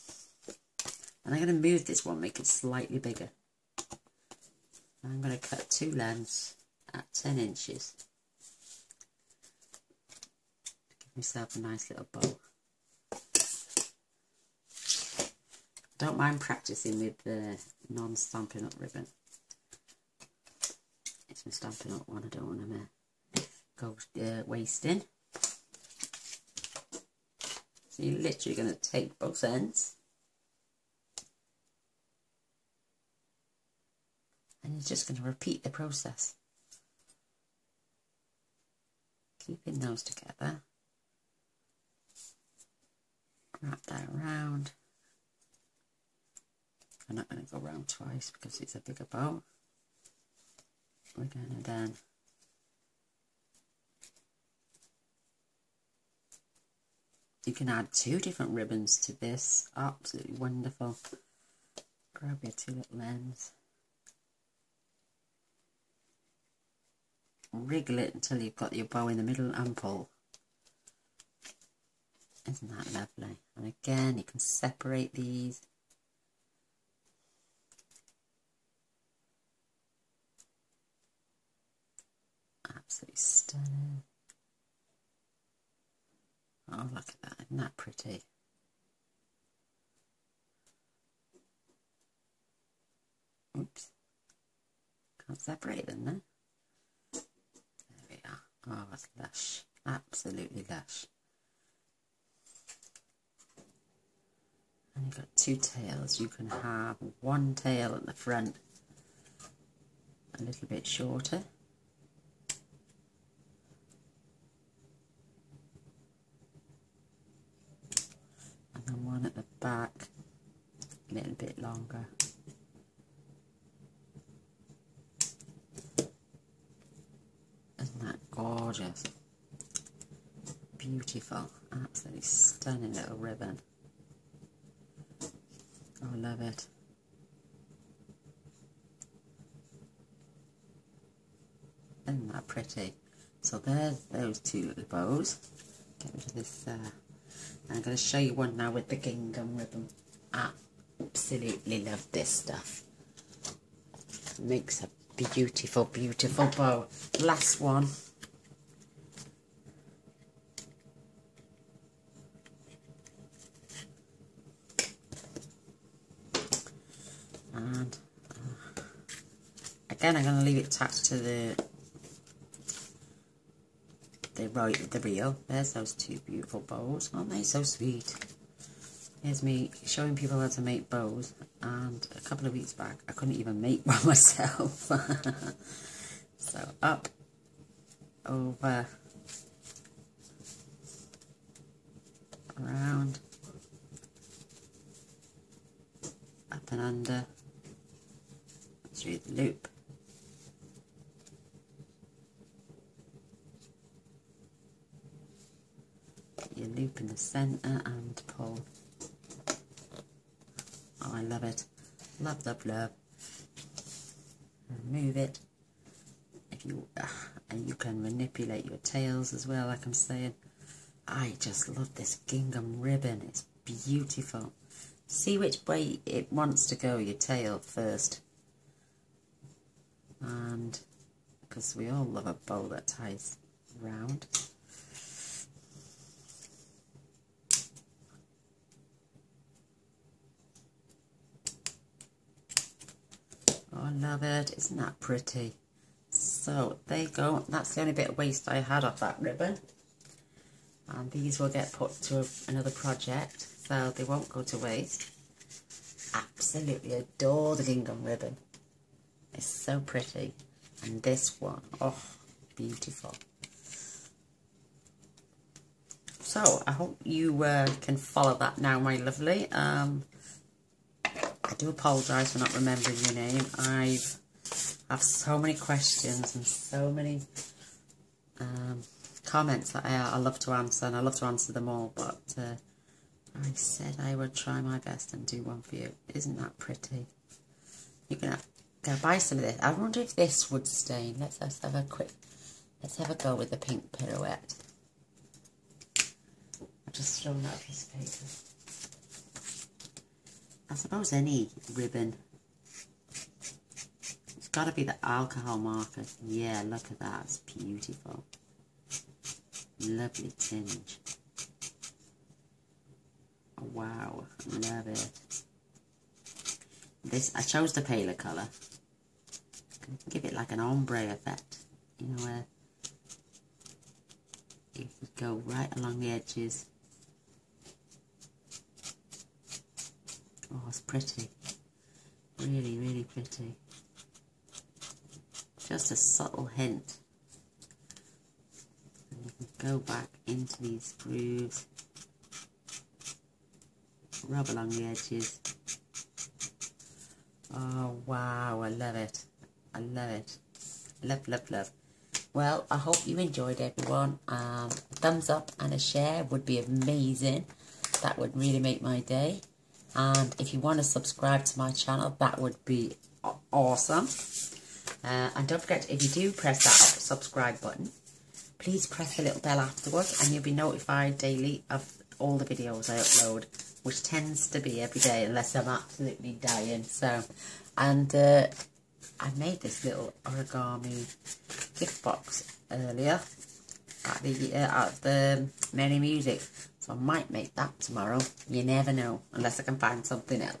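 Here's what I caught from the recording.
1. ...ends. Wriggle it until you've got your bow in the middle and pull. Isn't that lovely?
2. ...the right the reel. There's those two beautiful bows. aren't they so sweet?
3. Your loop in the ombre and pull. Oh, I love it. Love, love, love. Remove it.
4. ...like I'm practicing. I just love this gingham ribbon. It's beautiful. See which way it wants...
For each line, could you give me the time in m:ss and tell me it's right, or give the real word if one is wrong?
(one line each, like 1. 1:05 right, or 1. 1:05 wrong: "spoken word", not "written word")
1. 1:03 right
2. 2:54 right
3. 3:26 wrong: "centre", not "ombre"
4. 3:39 wrong: "saying", not "practicing".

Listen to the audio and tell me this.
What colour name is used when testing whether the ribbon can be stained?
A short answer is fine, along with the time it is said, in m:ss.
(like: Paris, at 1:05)
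pink pirouette, at 4:53.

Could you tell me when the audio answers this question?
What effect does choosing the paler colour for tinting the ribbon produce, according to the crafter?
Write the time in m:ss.
5:20.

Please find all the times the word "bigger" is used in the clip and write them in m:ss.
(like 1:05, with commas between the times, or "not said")
0:02, 0:48.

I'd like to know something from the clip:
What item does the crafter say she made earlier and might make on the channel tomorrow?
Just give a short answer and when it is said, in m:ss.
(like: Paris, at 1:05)
origami gift box, at 6:20.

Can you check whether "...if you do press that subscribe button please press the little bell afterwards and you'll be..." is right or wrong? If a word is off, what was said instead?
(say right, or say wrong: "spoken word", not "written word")
right.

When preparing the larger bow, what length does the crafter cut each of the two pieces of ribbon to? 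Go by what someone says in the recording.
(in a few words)
10 inches.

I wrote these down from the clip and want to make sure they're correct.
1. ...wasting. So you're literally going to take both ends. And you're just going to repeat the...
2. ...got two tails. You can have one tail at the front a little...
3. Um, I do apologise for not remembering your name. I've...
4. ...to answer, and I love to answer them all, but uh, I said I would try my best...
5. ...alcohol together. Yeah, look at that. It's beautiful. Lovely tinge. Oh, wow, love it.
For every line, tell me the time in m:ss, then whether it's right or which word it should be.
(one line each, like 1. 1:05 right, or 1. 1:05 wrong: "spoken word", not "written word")
1. 0:24 right
2. 1:45 right
3. 4:29 right
4. 4:40 right
5. 5:05 wrong: "marker", not "together".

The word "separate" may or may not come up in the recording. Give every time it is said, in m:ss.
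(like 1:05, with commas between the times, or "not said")
1:14, 1:35.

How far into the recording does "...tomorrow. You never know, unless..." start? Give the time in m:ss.
6:27.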